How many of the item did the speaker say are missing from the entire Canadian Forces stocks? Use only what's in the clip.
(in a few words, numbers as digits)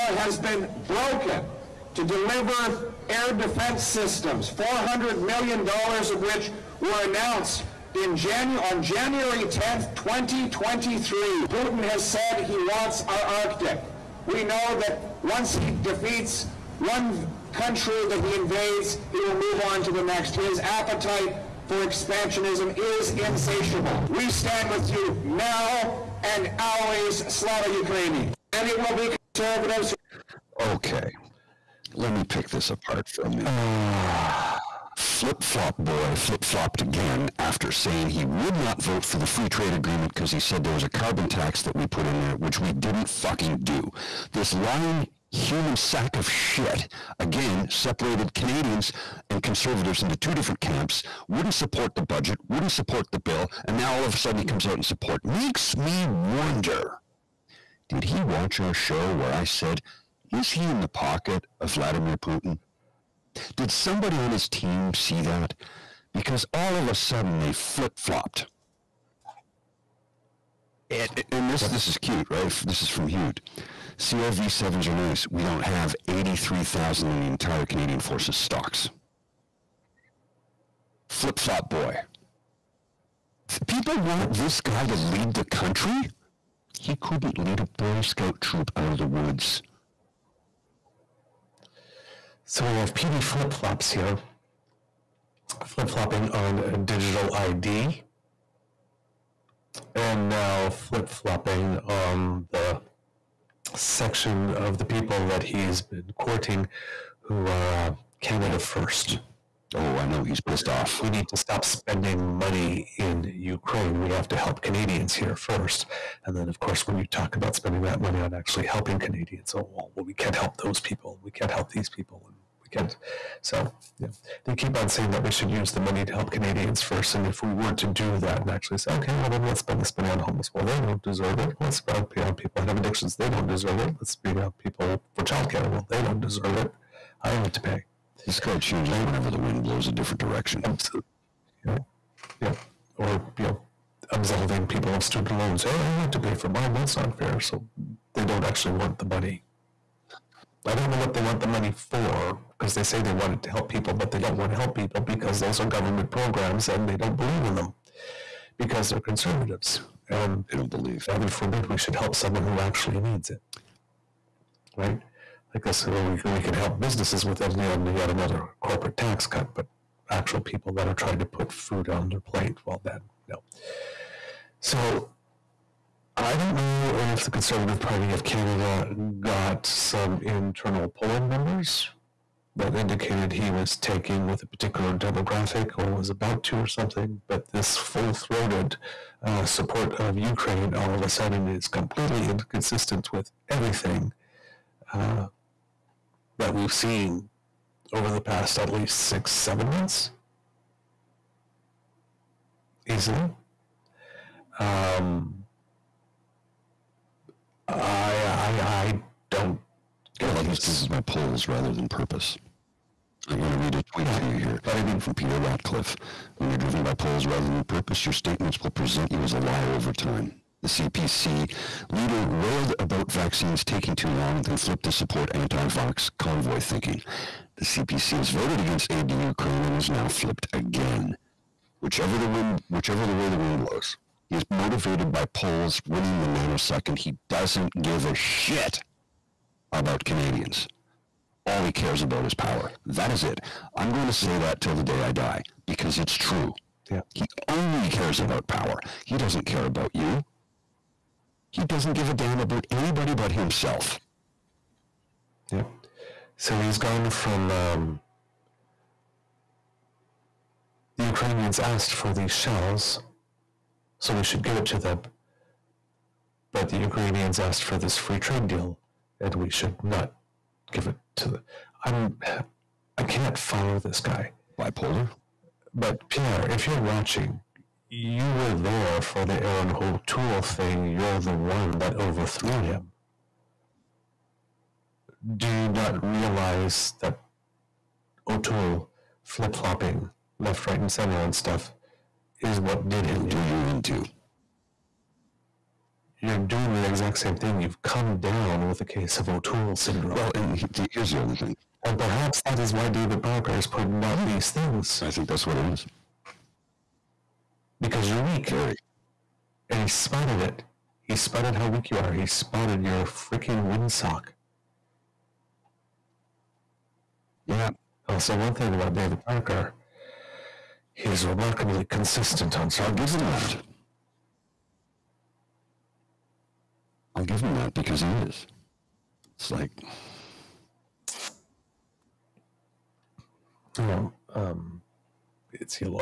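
83,000.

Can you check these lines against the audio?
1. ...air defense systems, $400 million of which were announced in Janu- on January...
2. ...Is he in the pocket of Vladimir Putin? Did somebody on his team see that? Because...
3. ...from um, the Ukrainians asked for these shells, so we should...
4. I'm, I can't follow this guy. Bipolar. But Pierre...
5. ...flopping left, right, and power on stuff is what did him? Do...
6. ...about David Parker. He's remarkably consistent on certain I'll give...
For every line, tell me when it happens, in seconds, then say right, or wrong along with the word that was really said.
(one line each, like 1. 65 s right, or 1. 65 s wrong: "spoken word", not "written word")
1. 3 s right
2. 60 s right
3. 257 s right
4. 271 s right
5. 289 s wrong: "center", not "power"
6. 318 s right.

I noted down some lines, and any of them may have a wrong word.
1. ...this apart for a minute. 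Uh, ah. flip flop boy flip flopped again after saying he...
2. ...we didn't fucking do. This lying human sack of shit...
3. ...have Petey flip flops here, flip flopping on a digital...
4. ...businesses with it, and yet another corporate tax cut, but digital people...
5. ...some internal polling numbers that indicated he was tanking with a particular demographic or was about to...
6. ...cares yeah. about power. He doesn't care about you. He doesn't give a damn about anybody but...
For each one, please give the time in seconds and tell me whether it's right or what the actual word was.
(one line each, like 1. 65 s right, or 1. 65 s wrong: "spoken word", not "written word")
1. 32 s right
2. 42 s right
3. 92 s right
4. 166 s wrong: "actual", not "digital"
5. 179 s right
6. 247 s right.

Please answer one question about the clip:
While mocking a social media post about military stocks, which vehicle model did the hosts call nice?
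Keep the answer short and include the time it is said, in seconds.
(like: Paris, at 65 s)
CRV sevens, at 73 s.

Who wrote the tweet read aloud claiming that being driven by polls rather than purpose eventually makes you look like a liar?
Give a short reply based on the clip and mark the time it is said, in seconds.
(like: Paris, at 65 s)
Peter Ratcliffe, at 215 s.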